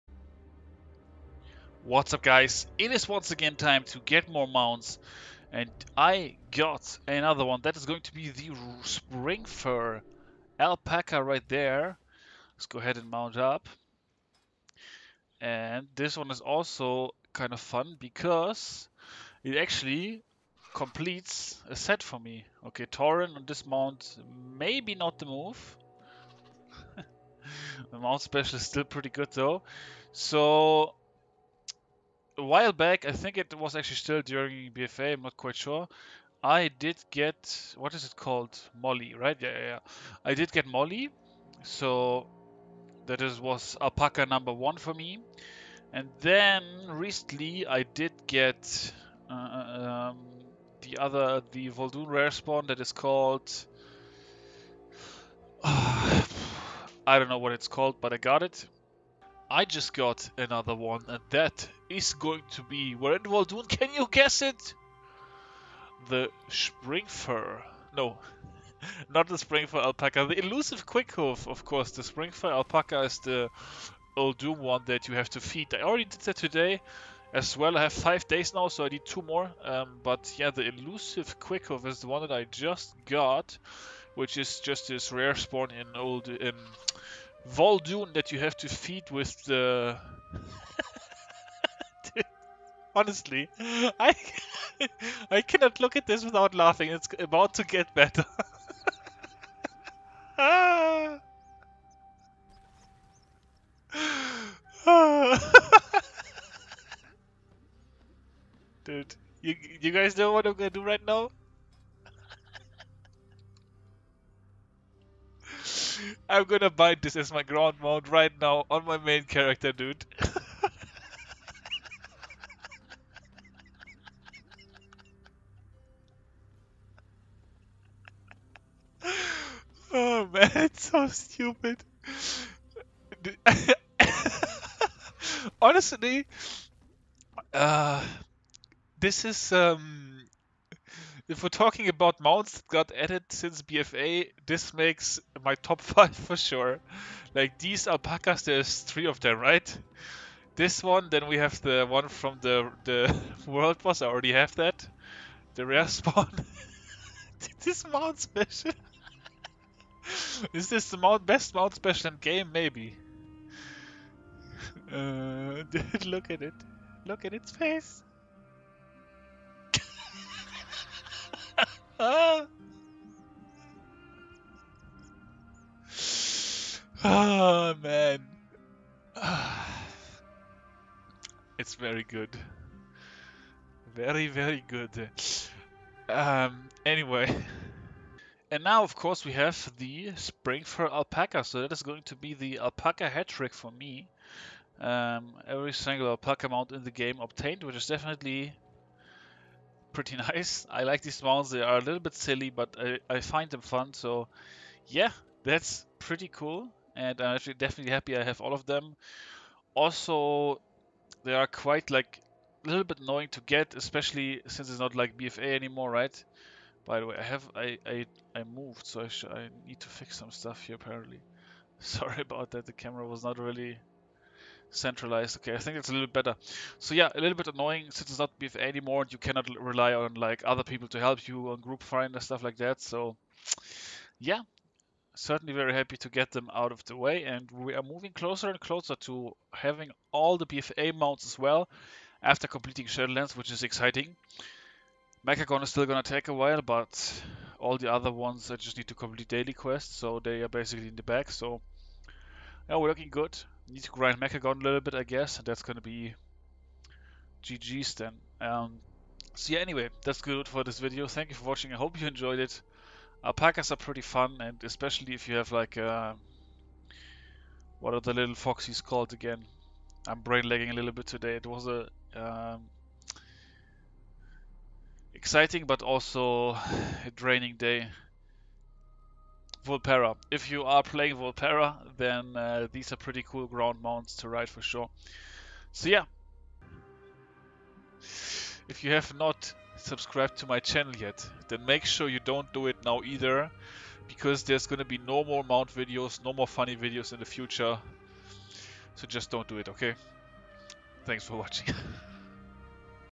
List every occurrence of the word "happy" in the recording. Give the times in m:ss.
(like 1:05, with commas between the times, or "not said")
3:27, 3:55.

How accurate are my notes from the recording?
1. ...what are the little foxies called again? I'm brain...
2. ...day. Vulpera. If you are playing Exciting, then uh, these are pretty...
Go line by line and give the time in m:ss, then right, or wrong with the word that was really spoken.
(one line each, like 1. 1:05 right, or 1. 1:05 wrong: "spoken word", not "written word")
1. 4:27 right
2. 4:37 wrong: "Vulpera", not "Exciting".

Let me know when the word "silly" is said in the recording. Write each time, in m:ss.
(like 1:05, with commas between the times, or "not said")
3:22.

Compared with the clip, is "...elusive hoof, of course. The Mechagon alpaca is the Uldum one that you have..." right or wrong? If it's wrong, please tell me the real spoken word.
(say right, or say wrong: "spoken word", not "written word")
wrong: "Springfur", not "Mechagon".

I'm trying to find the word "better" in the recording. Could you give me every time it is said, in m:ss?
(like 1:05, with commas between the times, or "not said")
1:37, 3:46.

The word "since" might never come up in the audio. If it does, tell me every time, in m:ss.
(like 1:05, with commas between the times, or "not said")
2:23, 3:34, 3:47.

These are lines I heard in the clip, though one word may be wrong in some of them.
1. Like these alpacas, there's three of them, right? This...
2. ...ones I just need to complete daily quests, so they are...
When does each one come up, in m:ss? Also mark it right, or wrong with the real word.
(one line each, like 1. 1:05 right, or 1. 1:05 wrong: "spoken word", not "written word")
1. 2:27 right
2. 4:08 right.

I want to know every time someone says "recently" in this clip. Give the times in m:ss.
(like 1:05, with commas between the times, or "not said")
0:46.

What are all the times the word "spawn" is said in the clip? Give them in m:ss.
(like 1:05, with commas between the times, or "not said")
0:52, 1:25, 2:35.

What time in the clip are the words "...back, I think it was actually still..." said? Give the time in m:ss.
0:32.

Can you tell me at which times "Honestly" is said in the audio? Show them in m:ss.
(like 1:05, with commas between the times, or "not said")
1:32, 2:15.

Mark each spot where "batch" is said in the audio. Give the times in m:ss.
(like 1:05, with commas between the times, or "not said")
not said.